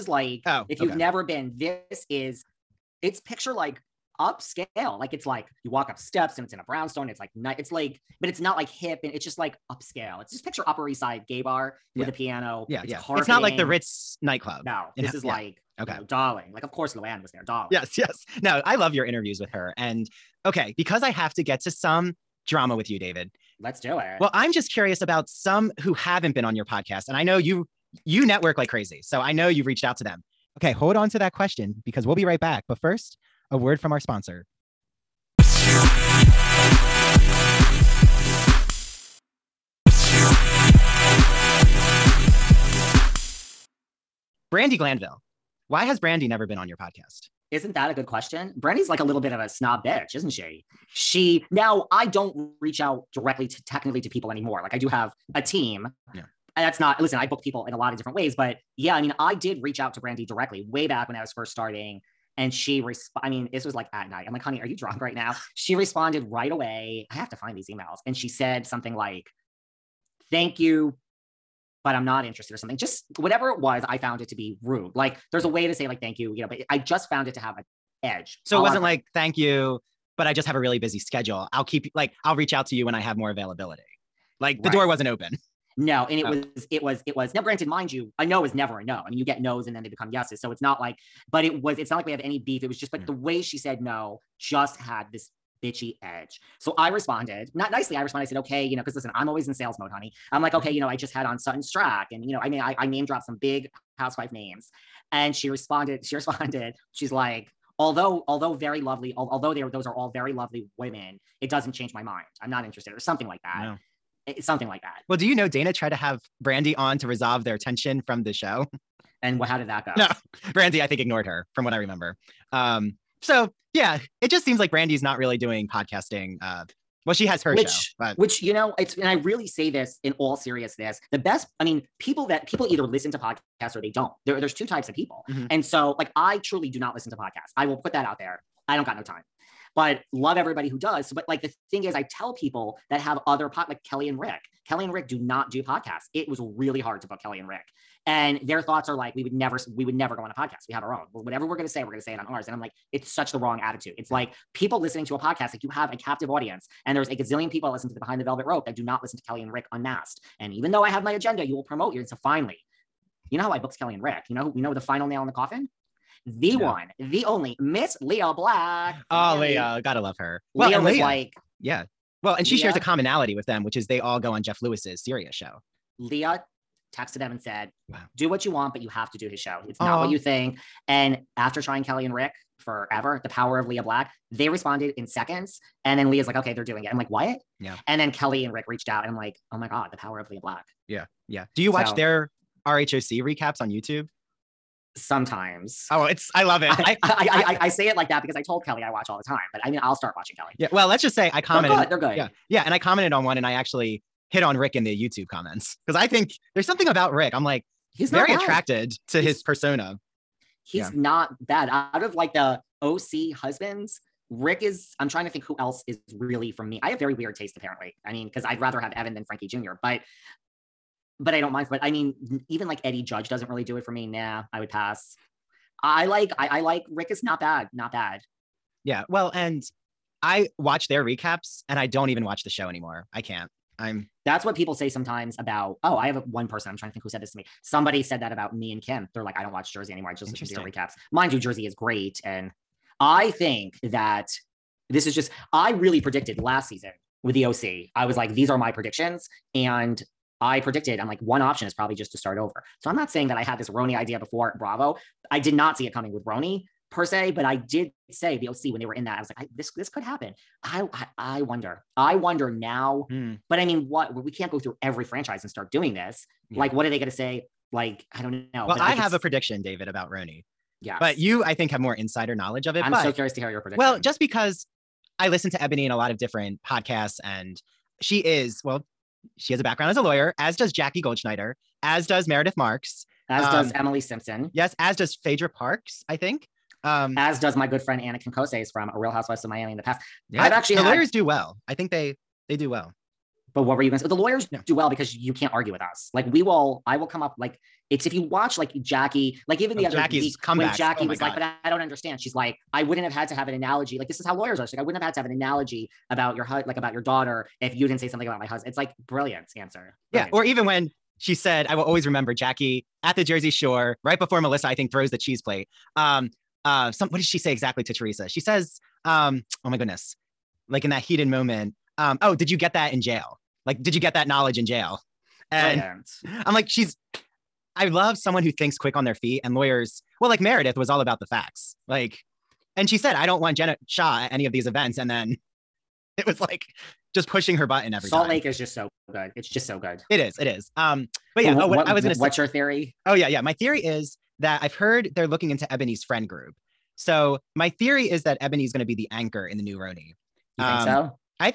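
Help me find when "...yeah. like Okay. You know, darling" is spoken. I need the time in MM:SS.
00:15.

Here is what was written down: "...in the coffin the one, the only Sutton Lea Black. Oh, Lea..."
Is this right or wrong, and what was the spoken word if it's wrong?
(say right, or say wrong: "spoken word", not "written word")
wrong: "Miss", not "Sutton".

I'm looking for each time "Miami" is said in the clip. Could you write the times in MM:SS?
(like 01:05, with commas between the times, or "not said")
04:49.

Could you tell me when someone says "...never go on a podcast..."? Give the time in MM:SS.
02:29.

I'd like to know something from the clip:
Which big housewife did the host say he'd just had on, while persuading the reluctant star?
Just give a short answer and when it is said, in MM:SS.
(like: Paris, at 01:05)
Sutton Stracke, at 01:41.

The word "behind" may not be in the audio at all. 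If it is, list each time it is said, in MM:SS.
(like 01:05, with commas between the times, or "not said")
02:37.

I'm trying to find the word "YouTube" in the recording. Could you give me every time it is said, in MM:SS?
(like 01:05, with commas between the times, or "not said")
03:13, 03:25.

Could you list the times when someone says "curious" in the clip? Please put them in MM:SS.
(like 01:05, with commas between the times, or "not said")
00:24, 04:33.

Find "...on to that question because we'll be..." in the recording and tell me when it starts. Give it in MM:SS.
00:30.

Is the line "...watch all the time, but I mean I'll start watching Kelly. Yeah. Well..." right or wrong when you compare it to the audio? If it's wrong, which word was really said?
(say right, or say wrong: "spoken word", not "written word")
right.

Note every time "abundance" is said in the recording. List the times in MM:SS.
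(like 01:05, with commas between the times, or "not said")
not said.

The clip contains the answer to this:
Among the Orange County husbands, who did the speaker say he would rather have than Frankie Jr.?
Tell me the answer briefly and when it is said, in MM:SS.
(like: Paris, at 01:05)
Evan, at 03:38.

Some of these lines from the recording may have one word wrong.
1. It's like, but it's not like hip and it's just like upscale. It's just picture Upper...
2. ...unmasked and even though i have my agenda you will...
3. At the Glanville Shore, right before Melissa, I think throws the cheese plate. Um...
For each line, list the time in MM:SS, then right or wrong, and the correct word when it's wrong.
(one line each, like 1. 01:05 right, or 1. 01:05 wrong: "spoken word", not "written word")
1. 00:07 right
2. 02:39 right
3. 05:13 wrong: "Jersey", not "Glanville".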